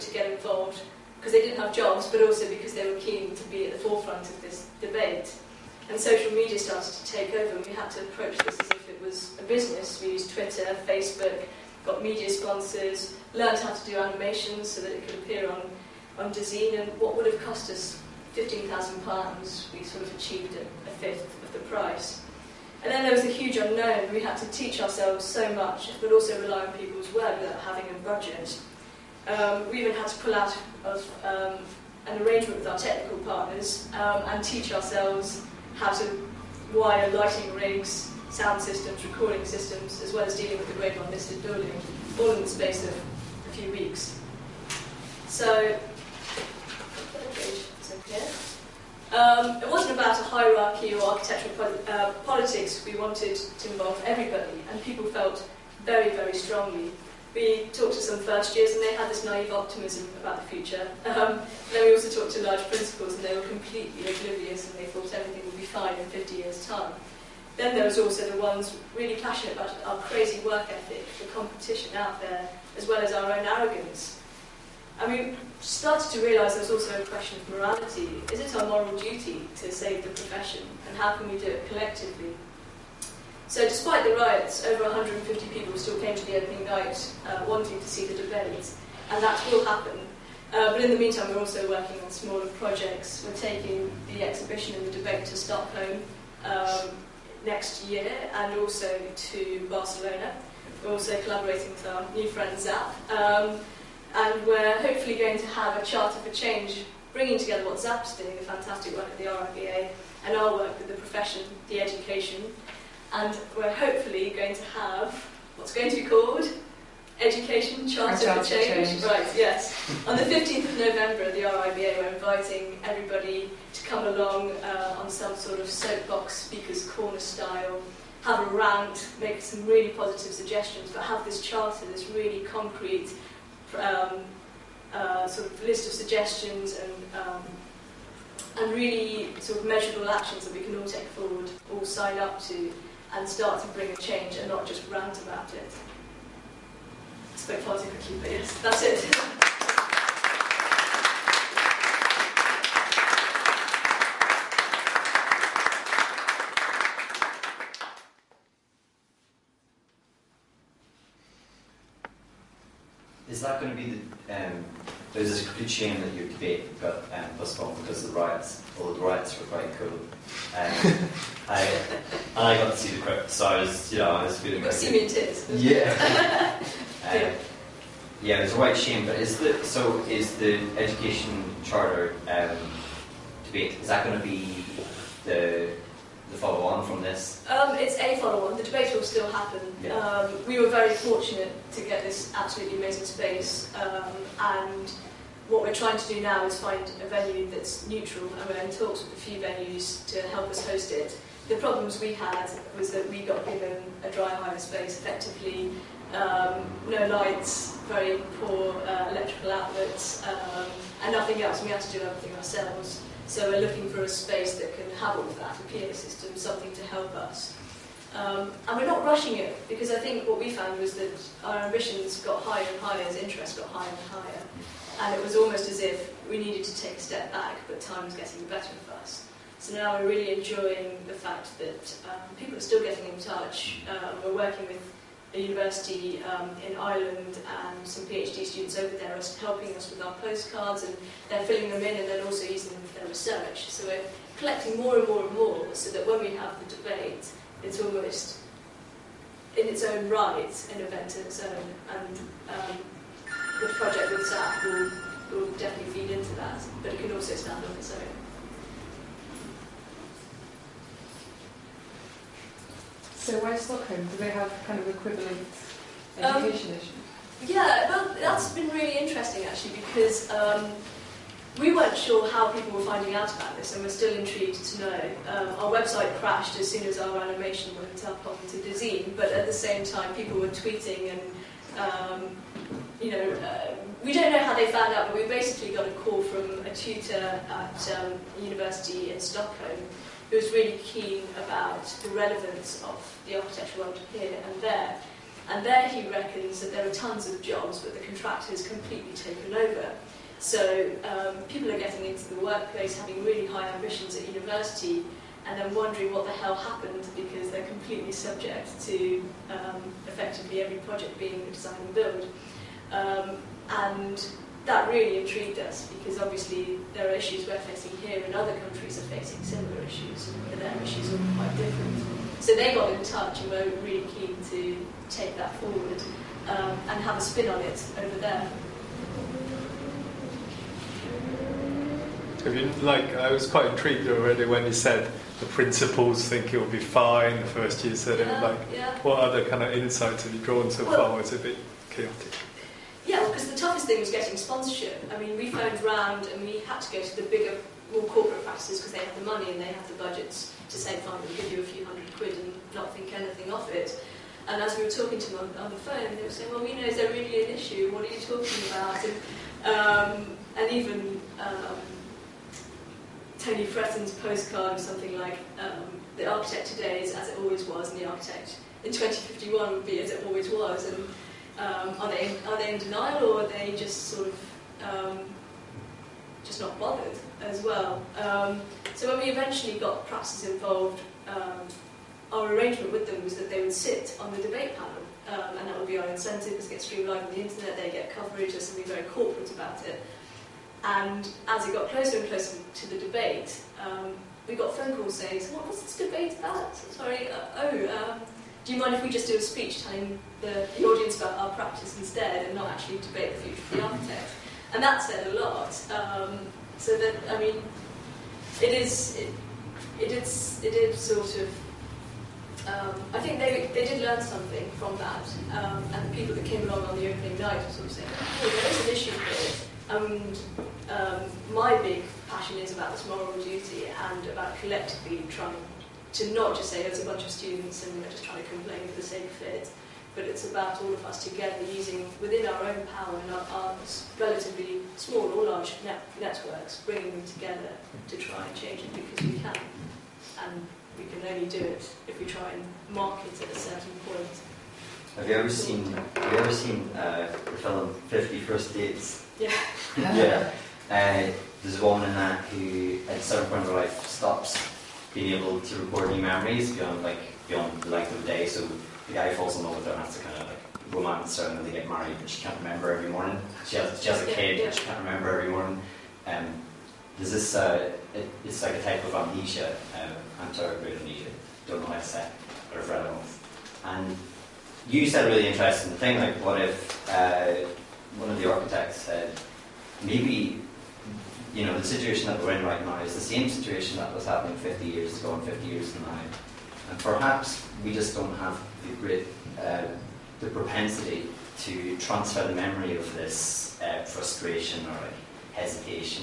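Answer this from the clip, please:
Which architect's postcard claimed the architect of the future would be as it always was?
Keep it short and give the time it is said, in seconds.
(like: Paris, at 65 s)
Tony Fretton, at 363 s.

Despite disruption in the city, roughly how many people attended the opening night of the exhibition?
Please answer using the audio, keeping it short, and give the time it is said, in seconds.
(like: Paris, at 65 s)
150, at 84 s.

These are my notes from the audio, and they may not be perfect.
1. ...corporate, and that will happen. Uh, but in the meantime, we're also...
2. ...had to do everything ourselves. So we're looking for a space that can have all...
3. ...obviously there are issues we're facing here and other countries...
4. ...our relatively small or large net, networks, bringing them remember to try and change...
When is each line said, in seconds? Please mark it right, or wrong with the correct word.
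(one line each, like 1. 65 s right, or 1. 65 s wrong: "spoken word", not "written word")
1. 88 s wrong: "debate", not "corporate"
2. 211 s right
3. 316 s right
4. 433 s wrong: "together", not "remember".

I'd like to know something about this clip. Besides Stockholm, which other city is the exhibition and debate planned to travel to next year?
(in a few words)
Barcelona.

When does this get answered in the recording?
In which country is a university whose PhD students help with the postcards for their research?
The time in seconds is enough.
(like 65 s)
236 s.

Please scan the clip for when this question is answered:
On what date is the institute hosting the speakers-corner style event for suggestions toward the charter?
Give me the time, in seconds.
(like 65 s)
120 s.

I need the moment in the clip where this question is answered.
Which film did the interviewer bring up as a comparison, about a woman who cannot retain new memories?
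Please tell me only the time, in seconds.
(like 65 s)
448 s.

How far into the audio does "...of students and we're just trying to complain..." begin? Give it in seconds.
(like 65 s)
427 s.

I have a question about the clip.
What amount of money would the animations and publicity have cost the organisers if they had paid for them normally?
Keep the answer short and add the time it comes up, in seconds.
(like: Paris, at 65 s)
£15,000, at 18 s.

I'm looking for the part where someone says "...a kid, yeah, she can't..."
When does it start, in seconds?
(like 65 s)
464 s.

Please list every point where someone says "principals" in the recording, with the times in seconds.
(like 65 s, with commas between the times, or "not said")
62 s, 335 s.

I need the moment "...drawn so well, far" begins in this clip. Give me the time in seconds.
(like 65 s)
340 s.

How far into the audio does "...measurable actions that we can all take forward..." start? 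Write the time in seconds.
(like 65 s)
139 s.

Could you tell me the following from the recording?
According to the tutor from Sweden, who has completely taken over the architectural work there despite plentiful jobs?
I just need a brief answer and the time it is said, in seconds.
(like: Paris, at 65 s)
The contractor, at 297 s.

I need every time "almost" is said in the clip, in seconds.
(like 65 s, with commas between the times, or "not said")
225 s, 247 s.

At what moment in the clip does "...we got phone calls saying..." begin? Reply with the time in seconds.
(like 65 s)
394 s.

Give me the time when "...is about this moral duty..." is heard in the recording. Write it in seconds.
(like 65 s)
422 s.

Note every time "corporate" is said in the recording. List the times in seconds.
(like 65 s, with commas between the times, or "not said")
348 s, 389 s.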